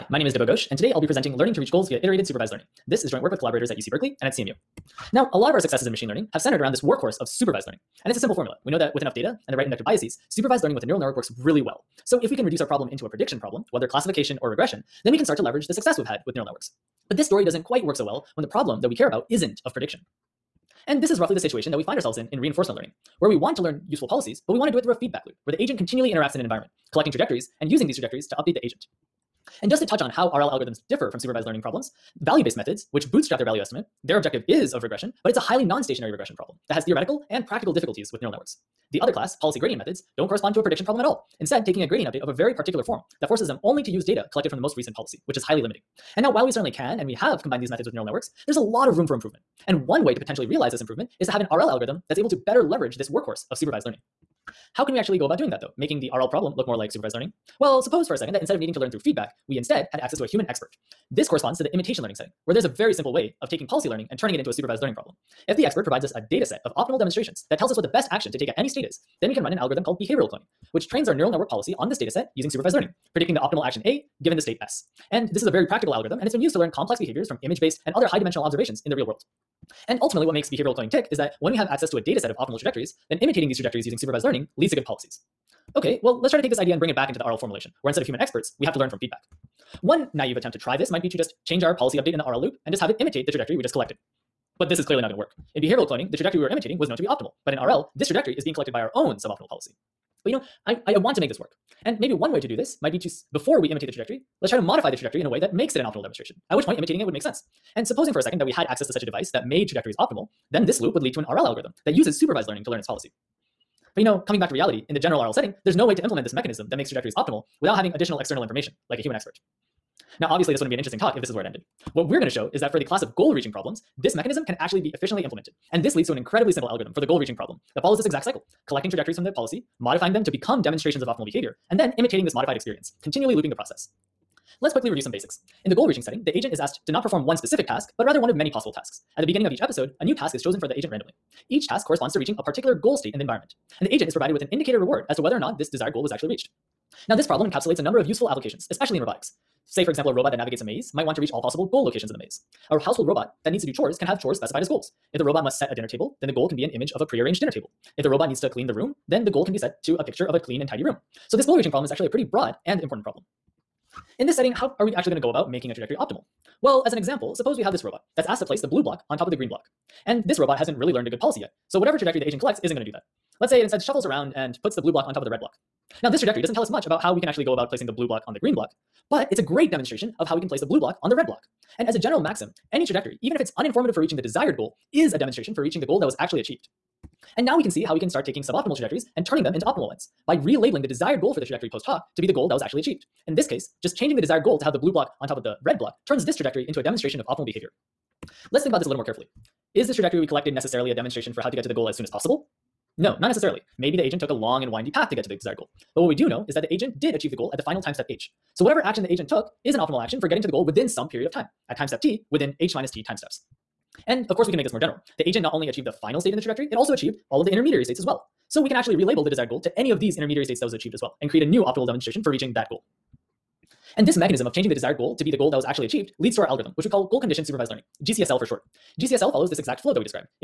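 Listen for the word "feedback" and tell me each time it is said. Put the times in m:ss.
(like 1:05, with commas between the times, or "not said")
0:25, 0:58, 1:28.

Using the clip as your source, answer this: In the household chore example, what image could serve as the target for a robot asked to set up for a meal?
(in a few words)
A prearranged dinner table.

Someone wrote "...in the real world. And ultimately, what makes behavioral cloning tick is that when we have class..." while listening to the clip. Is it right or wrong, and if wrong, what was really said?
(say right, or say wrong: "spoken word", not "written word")
wrong: "access", not "class".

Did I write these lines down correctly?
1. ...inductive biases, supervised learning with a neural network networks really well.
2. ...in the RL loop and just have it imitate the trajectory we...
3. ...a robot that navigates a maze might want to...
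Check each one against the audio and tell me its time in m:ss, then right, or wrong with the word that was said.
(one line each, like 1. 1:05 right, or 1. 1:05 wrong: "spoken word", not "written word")
1. 0:09 wrong: "works", not "networks"
2. 1:32 right
3. 2:30 right.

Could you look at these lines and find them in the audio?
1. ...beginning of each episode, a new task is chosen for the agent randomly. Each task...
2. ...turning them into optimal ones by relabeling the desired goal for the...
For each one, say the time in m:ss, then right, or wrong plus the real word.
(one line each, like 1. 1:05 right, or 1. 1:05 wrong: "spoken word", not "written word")
1. 2:19 right
2. 3:09 right.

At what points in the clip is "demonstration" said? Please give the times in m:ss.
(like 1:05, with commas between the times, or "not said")
1:06, 1:46, 2:10, 2:59, 3:05, 3:16, 3:20, 3:41.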